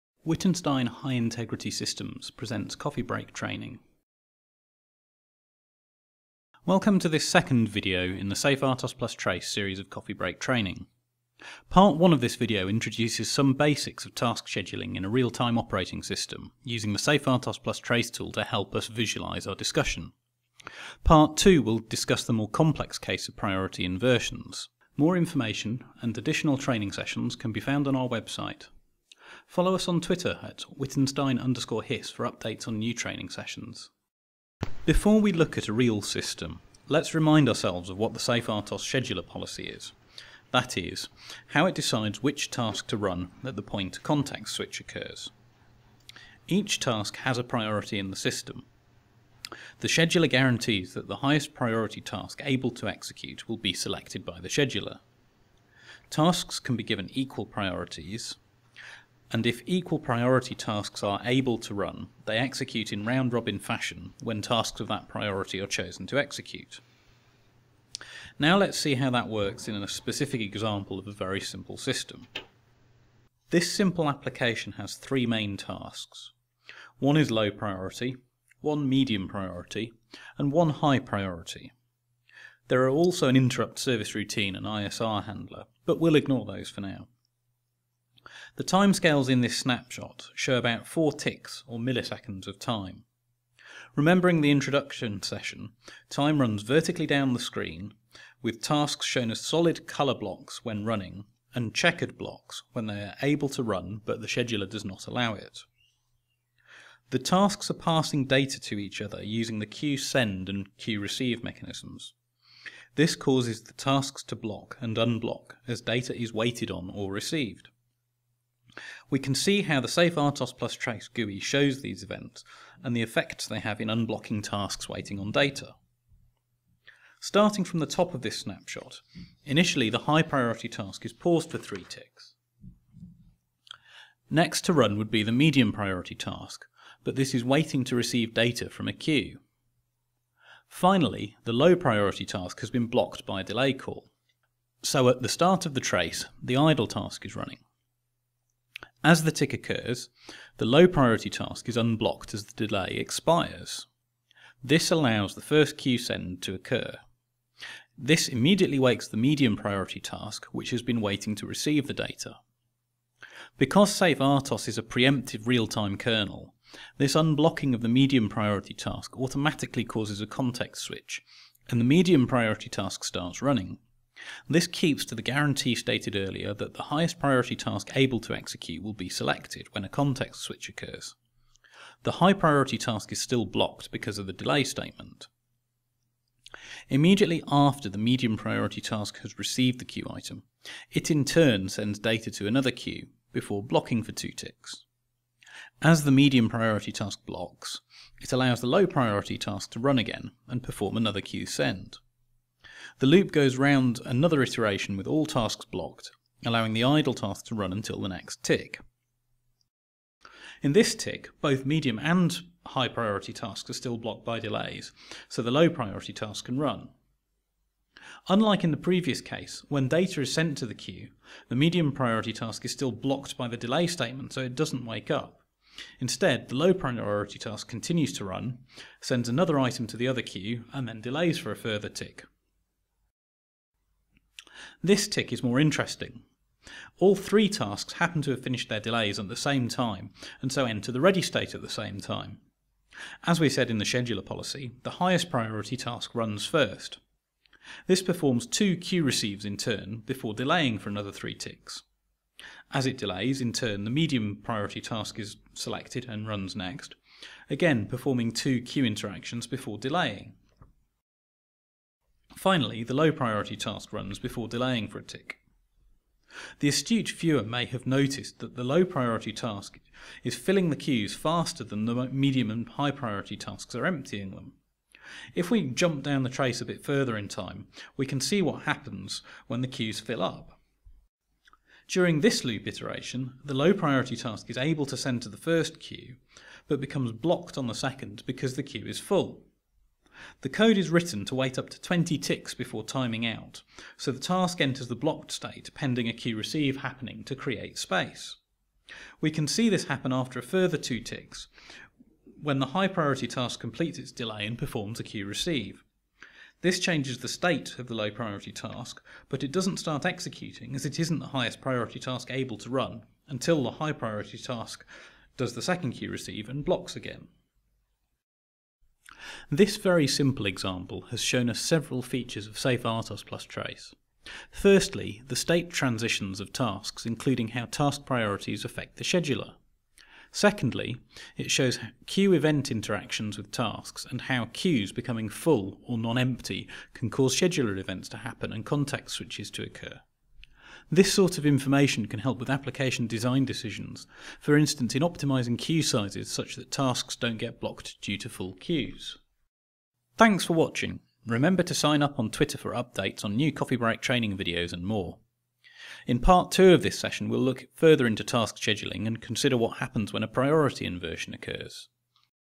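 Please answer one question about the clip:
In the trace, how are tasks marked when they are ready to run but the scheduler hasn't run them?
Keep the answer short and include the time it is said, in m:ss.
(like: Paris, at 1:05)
checkered blocks, at 1:41.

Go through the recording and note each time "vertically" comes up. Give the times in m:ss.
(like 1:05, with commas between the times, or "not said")
1:36.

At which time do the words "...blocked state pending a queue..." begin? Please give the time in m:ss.
4:54.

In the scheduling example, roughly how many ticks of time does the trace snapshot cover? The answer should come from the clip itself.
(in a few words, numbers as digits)
4.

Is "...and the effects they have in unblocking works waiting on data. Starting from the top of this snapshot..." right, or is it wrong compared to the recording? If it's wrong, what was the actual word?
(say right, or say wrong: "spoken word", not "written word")
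wrong: "tasks", not "works".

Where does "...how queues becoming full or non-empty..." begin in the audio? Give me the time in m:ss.
5:34.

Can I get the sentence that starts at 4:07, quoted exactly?
This performs two queue receives in turn before delaying for another three ticks.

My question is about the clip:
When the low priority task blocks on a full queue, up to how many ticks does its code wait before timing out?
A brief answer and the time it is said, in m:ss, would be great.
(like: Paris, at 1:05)
20, at 4:51.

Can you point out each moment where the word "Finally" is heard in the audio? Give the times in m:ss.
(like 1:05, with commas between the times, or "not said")
2:20, 4:22.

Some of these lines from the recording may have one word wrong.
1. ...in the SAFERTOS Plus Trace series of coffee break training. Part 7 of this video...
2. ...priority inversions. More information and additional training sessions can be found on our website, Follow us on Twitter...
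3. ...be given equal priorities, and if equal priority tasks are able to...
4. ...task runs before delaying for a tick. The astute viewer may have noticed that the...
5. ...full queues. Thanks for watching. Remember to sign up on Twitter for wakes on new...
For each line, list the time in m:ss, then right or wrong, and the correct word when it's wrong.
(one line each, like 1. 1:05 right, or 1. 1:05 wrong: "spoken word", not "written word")
1. 0:08 wrong: "1", not "7"
2. 0:23 right
3. 0:56 right
4. 4:23 right
5. 5:48 wrong: "updates", not "wakes".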